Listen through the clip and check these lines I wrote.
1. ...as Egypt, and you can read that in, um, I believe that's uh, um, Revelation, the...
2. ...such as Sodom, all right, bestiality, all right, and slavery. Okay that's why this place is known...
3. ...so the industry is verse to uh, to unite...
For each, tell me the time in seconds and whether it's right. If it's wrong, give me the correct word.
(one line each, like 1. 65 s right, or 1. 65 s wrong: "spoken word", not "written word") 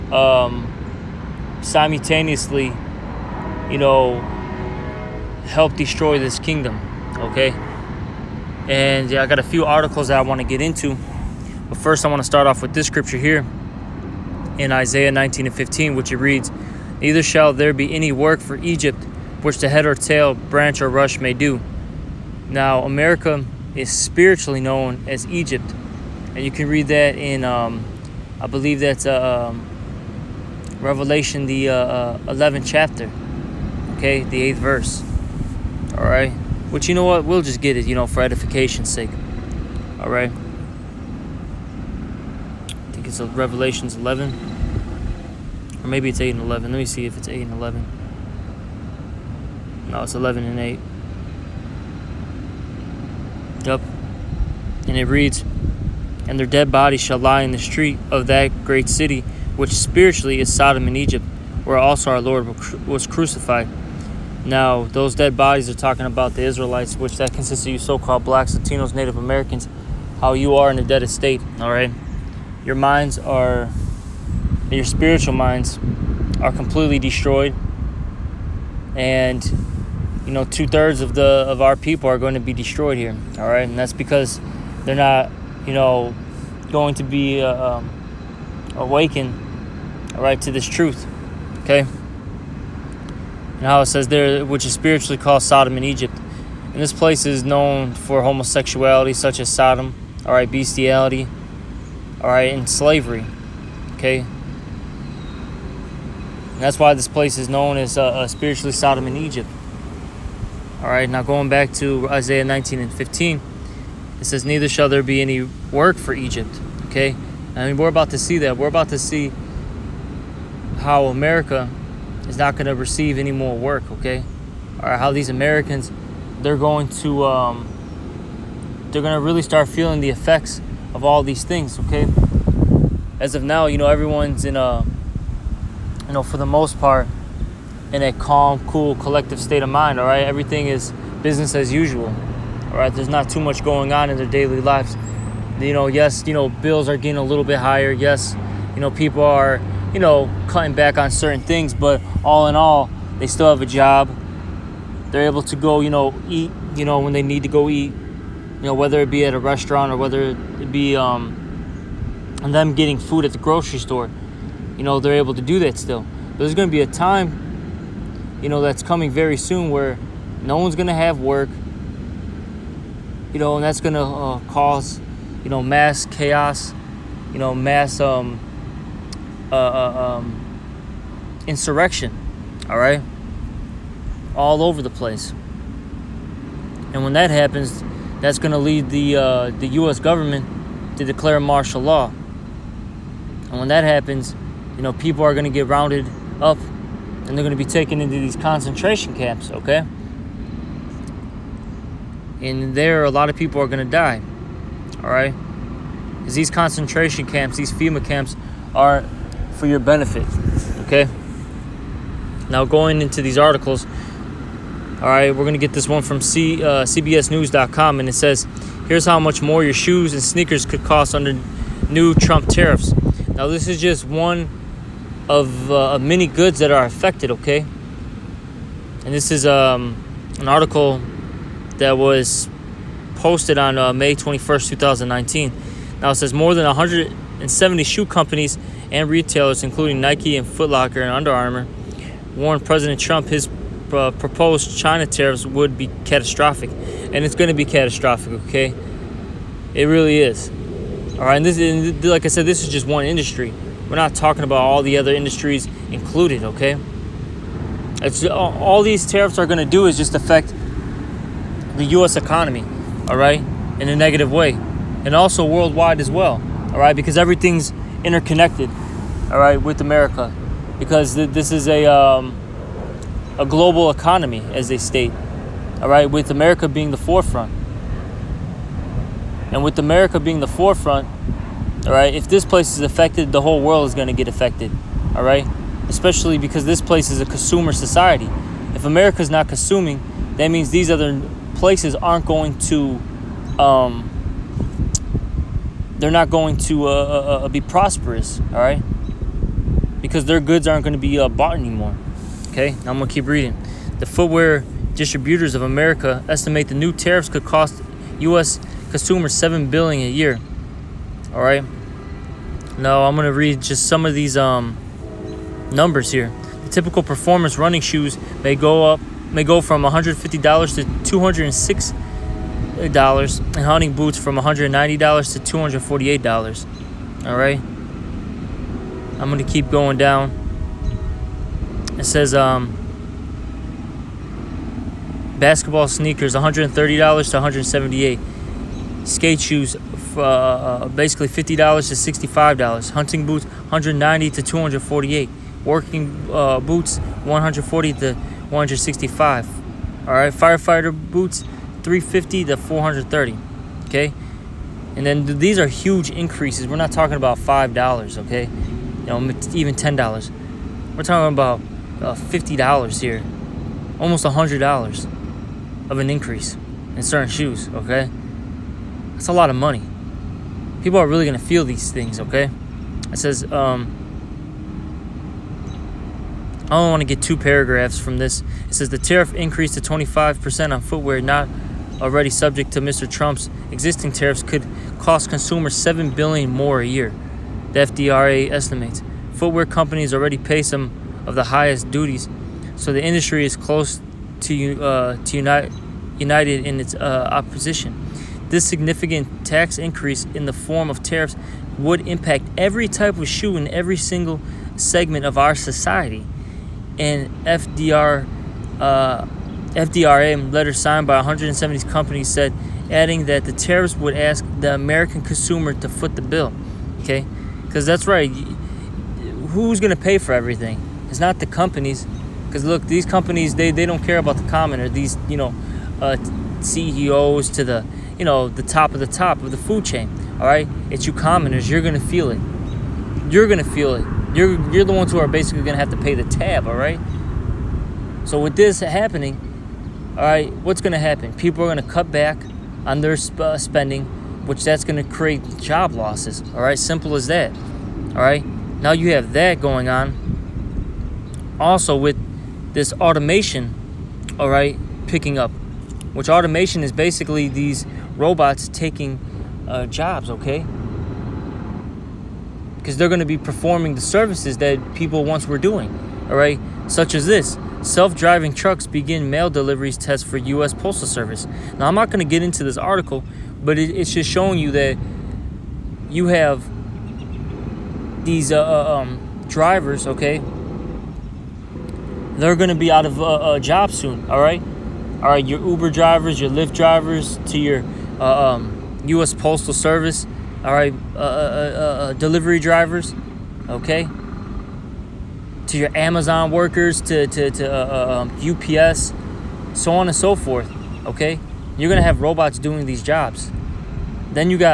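1. 25 s right
2. 99 s right
3. 392 s wrong: "close", not "verse".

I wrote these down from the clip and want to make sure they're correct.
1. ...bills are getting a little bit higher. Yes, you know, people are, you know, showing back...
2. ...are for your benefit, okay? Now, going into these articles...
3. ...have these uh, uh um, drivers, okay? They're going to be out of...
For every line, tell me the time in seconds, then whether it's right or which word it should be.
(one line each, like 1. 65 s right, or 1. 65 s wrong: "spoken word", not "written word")
1. 146 s wrong: "cutting", not "showing"
2. 208 s right
3. 476 s right.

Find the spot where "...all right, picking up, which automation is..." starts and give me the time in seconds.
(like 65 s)
454 s.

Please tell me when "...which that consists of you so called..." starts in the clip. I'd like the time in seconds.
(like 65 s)
66 s.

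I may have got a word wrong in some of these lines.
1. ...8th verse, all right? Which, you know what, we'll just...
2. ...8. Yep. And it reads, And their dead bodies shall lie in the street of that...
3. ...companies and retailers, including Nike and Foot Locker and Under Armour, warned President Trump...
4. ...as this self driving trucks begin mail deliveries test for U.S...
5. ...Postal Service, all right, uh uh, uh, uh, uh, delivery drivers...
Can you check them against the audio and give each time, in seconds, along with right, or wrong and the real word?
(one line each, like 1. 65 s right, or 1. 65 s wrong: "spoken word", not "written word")
1. 34 s right
2. 50 s right
3. 238 s right
4. 467 s right
5. 489 s right.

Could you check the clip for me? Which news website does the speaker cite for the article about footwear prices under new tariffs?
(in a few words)
CBSNews.com.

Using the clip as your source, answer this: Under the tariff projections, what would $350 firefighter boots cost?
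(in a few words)
$430.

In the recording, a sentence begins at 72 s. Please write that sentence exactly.
Your minds are your spiritual minds are completely destroyed.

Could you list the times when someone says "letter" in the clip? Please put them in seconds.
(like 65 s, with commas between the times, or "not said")
410 s.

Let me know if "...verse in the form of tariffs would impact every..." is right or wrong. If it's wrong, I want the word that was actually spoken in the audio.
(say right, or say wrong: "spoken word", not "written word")
wrong: "increase", not "verse".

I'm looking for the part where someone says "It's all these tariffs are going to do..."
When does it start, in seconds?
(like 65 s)
258 s.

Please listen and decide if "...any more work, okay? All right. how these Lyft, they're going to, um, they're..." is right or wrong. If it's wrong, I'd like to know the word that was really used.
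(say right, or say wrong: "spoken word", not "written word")
wrong: "Americans", not "Lyft".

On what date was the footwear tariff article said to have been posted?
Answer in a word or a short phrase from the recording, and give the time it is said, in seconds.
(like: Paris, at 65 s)
May 21st, 2019, at 233 s.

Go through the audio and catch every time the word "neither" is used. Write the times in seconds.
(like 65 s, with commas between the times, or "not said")
17 s, 114 s.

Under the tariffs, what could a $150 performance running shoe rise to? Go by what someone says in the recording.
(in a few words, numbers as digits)
$206.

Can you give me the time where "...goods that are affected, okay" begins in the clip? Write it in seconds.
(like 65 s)
226 s.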